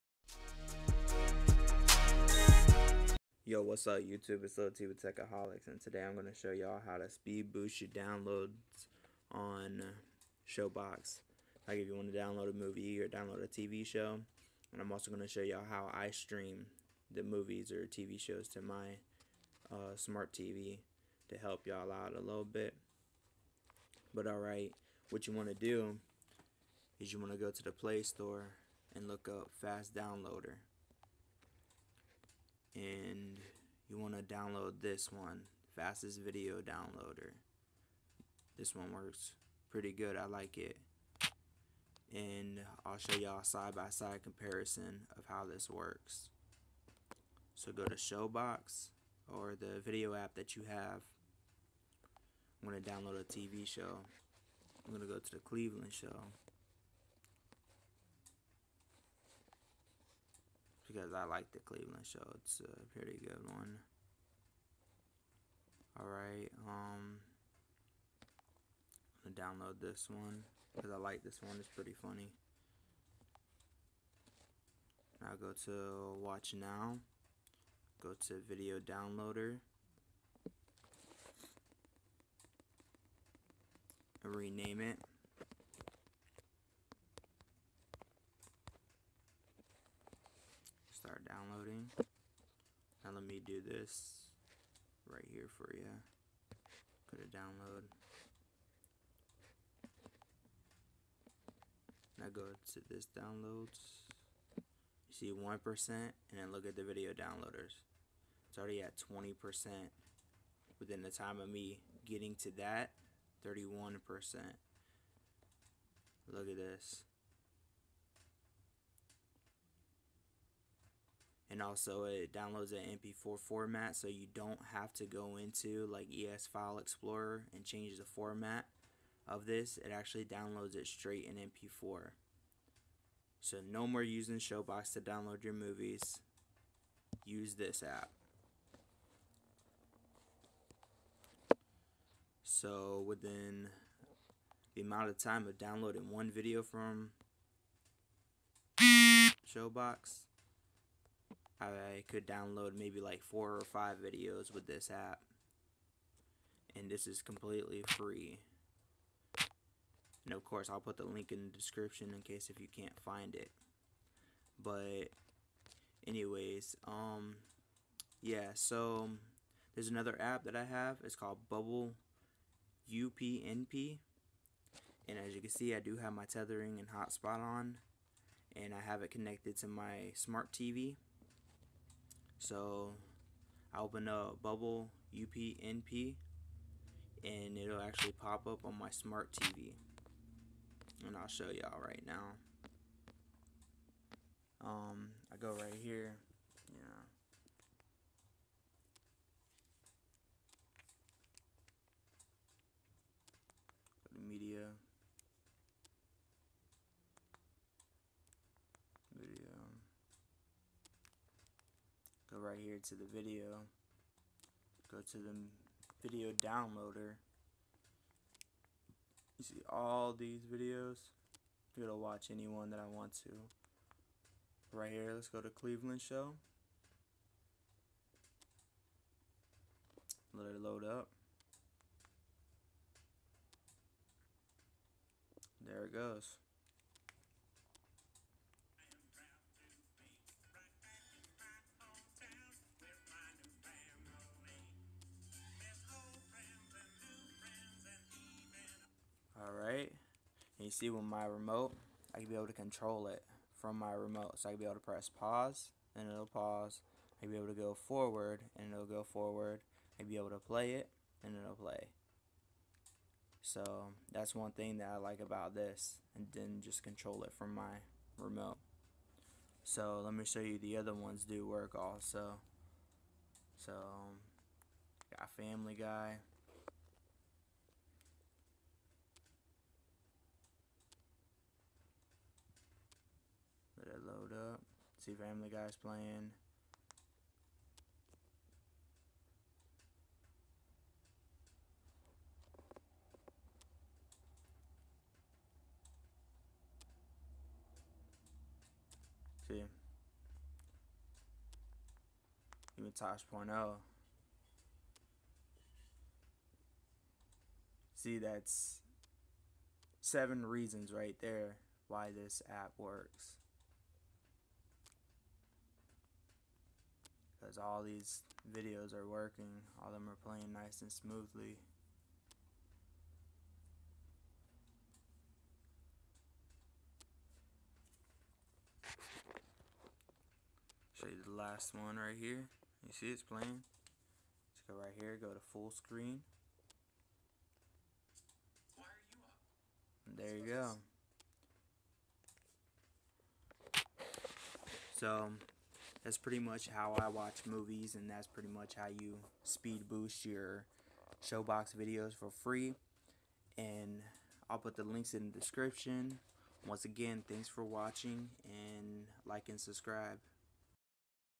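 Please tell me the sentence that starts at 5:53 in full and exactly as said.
And I'll put the links in the description.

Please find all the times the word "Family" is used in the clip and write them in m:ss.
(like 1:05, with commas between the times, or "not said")
4:35, 4:45.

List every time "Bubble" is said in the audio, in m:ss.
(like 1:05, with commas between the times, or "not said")
2:51, 3:04.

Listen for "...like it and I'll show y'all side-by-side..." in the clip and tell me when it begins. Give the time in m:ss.
0:40.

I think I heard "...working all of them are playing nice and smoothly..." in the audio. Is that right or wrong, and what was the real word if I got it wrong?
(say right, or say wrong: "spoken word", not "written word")
right.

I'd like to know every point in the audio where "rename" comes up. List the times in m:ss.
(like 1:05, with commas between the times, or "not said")
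1:24.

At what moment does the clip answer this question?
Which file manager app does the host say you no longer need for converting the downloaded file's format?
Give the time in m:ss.
2:06.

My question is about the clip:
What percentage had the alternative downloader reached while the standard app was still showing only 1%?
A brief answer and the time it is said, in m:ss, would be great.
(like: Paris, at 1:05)
20%, at 1:48.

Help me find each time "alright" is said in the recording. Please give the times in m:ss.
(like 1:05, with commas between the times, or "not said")
0:24, 1:05.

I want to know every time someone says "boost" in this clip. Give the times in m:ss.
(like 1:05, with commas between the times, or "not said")
0:07, 5:49.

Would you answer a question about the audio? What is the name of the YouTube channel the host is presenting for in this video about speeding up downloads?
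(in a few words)
Techaholics.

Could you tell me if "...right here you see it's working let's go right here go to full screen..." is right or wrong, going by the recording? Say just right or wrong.
wrong.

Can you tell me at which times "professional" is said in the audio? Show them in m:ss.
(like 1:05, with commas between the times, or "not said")
not said.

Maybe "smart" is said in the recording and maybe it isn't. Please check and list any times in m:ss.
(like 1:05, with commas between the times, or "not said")
0:19, 3:00, 3:08.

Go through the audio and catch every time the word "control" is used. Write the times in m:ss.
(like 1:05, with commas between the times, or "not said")
4:12, 4:26.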